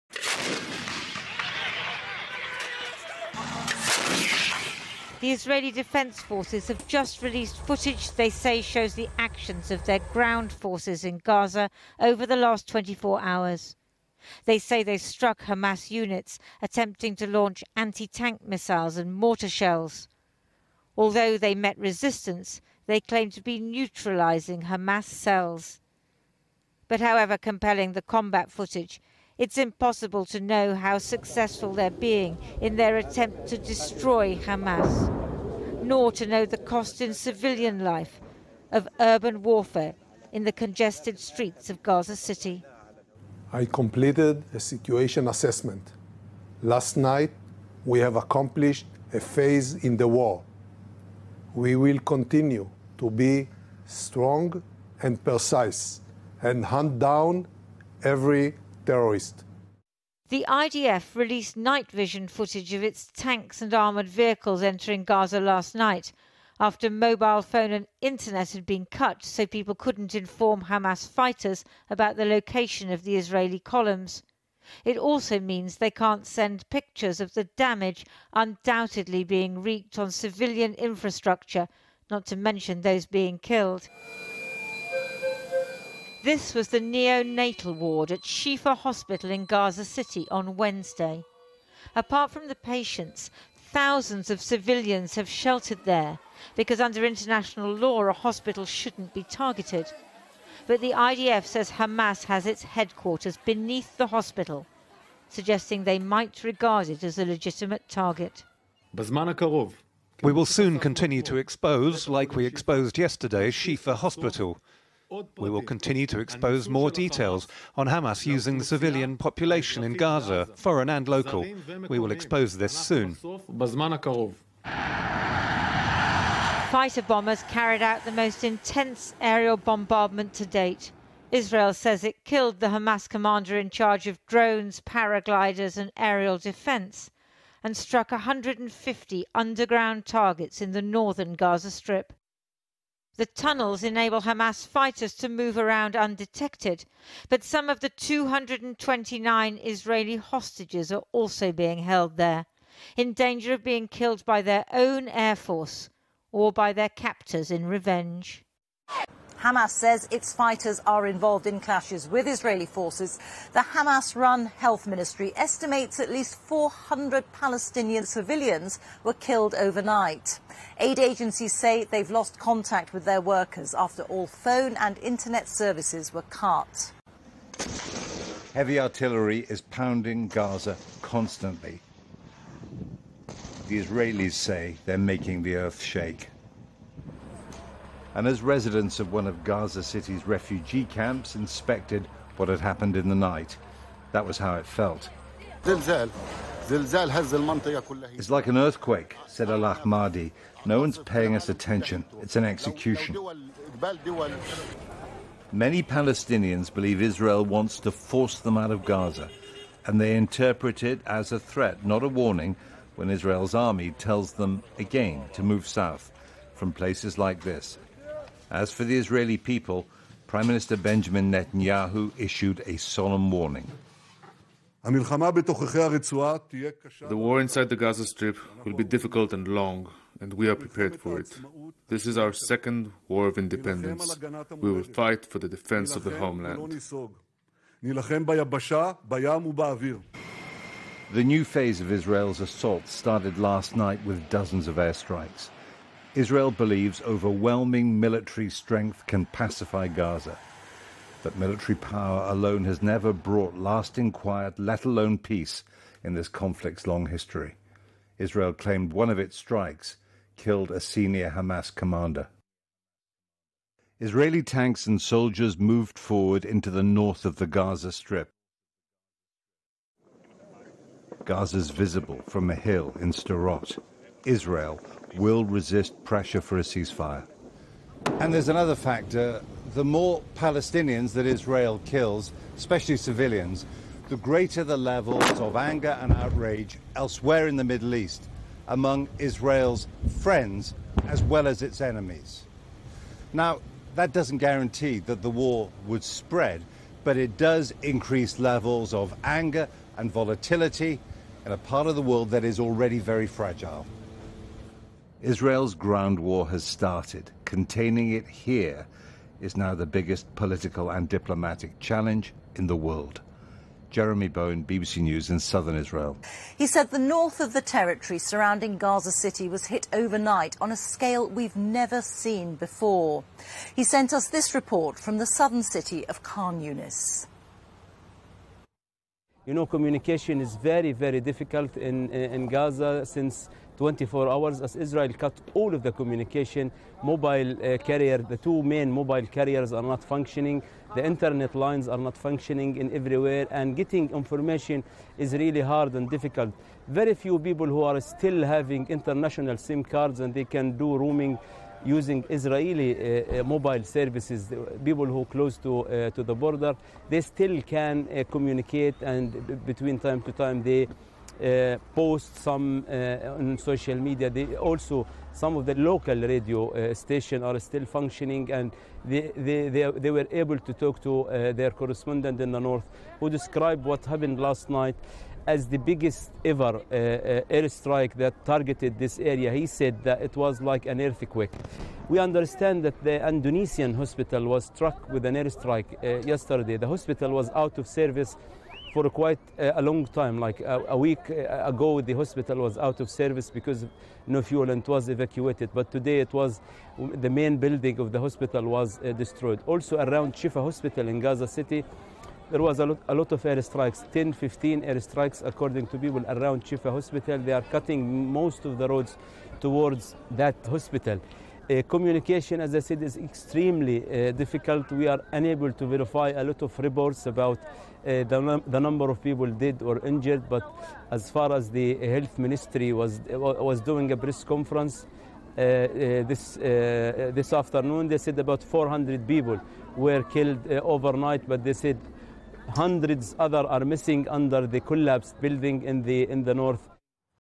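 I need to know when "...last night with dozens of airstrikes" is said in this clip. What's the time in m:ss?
4:03.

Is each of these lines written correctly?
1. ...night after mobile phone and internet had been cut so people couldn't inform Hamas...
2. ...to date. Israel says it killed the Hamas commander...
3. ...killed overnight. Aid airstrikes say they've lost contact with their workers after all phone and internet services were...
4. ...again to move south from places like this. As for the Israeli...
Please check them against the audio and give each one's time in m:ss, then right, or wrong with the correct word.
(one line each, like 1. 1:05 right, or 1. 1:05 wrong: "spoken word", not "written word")
1. 1:05 right
2. 2:10 right
3. 2:49 wrong: "agencies", not "airstrikes"
4. 3:34 right.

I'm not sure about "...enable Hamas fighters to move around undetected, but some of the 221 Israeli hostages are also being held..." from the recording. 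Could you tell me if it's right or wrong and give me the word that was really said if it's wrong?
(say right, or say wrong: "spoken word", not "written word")
wrong: "229", not "221".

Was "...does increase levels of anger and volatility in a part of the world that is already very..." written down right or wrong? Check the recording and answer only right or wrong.
right.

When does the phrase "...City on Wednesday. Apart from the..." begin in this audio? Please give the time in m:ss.
1:29.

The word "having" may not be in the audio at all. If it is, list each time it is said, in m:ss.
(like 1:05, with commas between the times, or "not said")
5:48.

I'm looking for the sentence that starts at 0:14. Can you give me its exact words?
They say they struck Hamas units attempting to launch anti tank missiles and mortar shells.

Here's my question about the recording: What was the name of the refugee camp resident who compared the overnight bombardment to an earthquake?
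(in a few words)
Al Ahmadi.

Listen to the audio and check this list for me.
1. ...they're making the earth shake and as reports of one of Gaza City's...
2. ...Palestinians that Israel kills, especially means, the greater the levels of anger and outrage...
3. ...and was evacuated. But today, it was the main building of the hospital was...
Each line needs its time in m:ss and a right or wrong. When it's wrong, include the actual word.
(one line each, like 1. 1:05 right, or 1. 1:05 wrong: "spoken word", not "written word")
1. 3:04 wrong: "residents", not "reports"
2. 4:40 wrong: "civilians", not "means"
3. 6:34 right.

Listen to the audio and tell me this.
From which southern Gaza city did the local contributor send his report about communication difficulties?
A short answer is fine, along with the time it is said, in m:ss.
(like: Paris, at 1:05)
Khan Yunis, at 5:26.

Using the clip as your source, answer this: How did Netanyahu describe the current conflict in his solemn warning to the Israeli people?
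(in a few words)
second war of independence.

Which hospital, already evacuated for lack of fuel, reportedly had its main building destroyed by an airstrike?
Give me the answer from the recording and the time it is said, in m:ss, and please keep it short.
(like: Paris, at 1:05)
Indonesian hospital, at 6:23.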